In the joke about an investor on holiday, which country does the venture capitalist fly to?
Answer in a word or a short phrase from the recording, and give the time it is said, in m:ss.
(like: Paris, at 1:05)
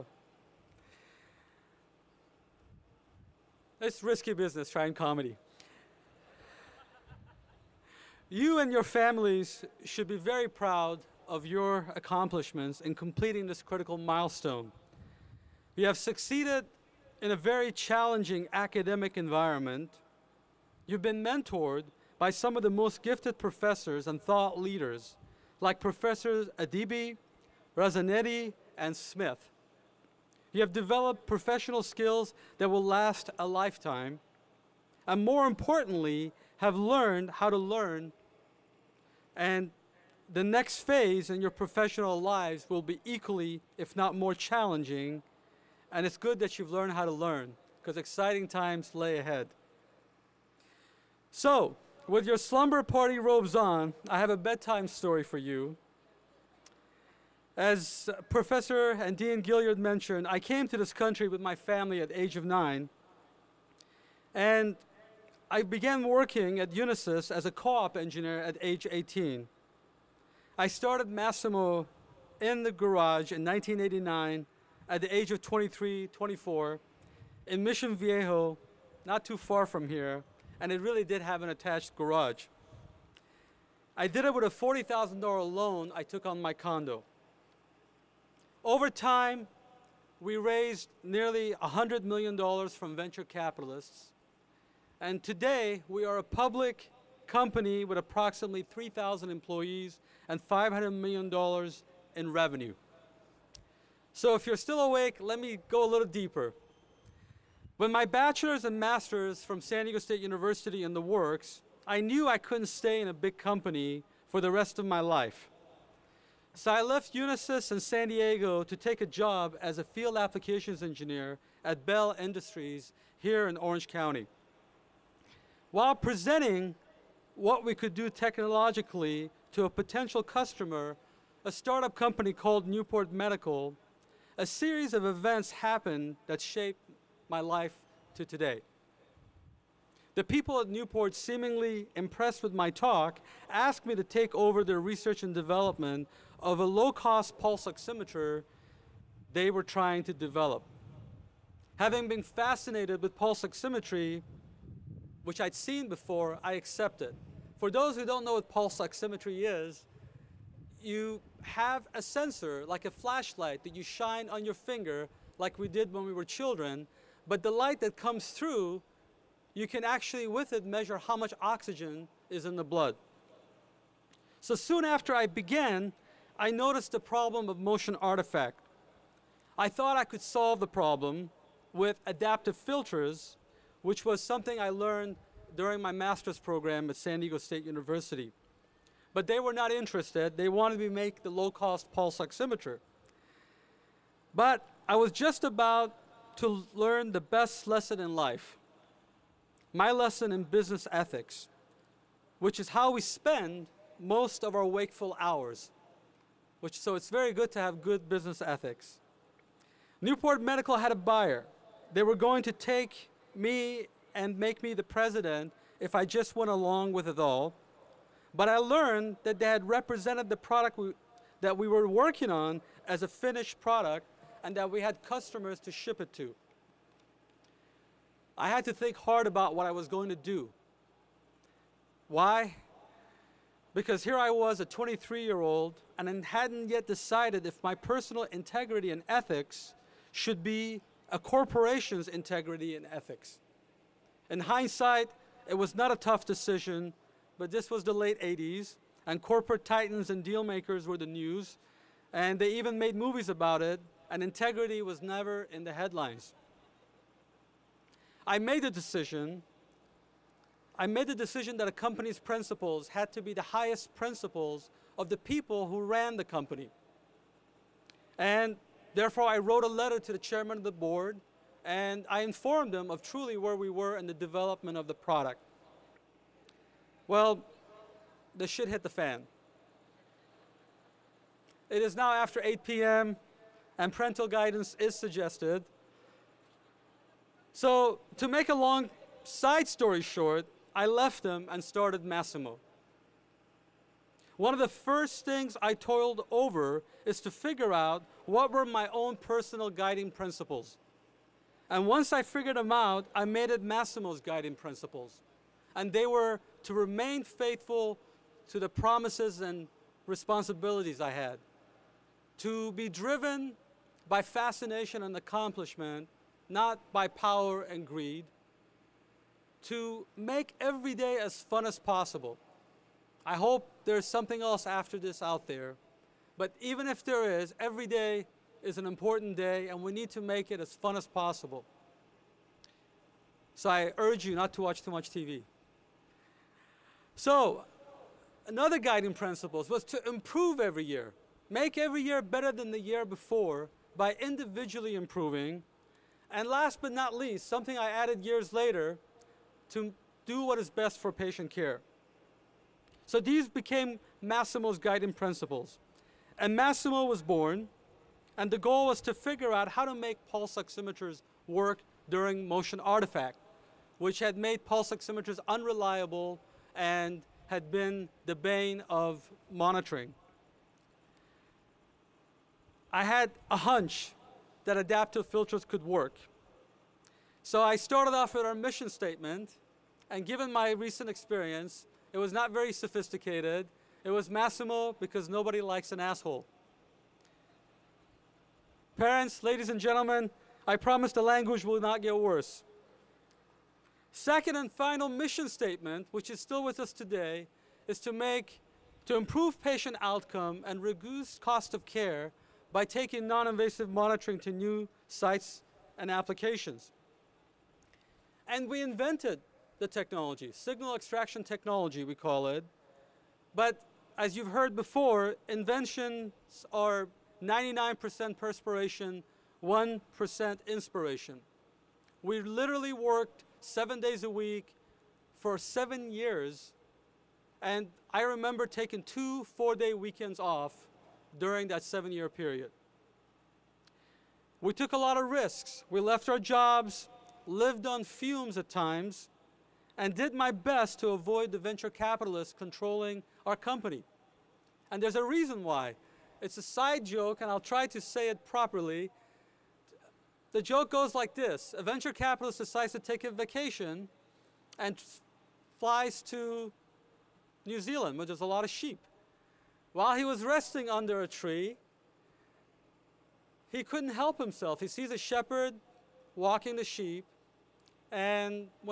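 New Zealand, at 7:37.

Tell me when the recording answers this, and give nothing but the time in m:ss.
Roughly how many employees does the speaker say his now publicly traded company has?
1:38.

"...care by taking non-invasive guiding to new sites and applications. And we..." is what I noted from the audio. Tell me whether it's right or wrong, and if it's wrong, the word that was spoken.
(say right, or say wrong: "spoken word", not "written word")
wrong: "monitoring", not "guiding".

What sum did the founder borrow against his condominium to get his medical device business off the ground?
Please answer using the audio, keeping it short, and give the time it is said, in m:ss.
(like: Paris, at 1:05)
$40,000, at 1:24.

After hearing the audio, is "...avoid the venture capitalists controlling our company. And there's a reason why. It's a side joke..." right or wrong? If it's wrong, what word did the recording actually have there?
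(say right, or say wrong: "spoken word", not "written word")
right.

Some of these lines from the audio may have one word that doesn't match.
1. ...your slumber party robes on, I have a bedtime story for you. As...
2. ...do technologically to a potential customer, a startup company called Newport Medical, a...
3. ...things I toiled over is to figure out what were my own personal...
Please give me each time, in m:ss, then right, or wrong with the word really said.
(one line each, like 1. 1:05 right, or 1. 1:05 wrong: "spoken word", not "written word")
1. 0:52 right
2. 2:07 right
3. 4:55 right.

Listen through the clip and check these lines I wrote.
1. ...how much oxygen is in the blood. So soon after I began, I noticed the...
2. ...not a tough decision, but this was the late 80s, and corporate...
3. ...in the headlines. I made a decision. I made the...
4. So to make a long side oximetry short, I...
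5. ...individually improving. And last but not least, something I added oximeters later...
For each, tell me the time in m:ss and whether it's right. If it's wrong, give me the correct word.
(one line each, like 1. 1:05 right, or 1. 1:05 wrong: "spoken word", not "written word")
1. 2:50 right
2. 4:05 right
3. 4:15 right
4. 4:47 wrong: "story", not "oximetry"
5. 5:44 wrong: "years", not "oximeters".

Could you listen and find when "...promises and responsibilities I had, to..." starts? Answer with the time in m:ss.
5:08.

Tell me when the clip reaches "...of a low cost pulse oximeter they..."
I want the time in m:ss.
2:26.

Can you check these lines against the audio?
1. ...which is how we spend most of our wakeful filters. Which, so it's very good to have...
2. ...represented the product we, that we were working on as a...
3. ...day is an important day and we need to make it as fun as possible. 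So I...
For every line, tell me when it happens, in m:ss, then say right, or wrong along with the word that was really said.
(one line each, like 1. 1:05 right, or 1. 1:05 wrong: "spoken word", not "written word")
1. 3:22 wrong: "hours", not "filters"
2. 3:39 right
3. 5:27 right.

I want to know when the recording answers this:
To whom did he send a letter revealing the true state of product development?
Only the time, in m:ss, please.
4:30.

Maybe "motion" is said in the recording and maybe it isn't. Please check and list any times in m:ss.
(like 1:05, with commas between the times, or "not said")
2:57, 6:02.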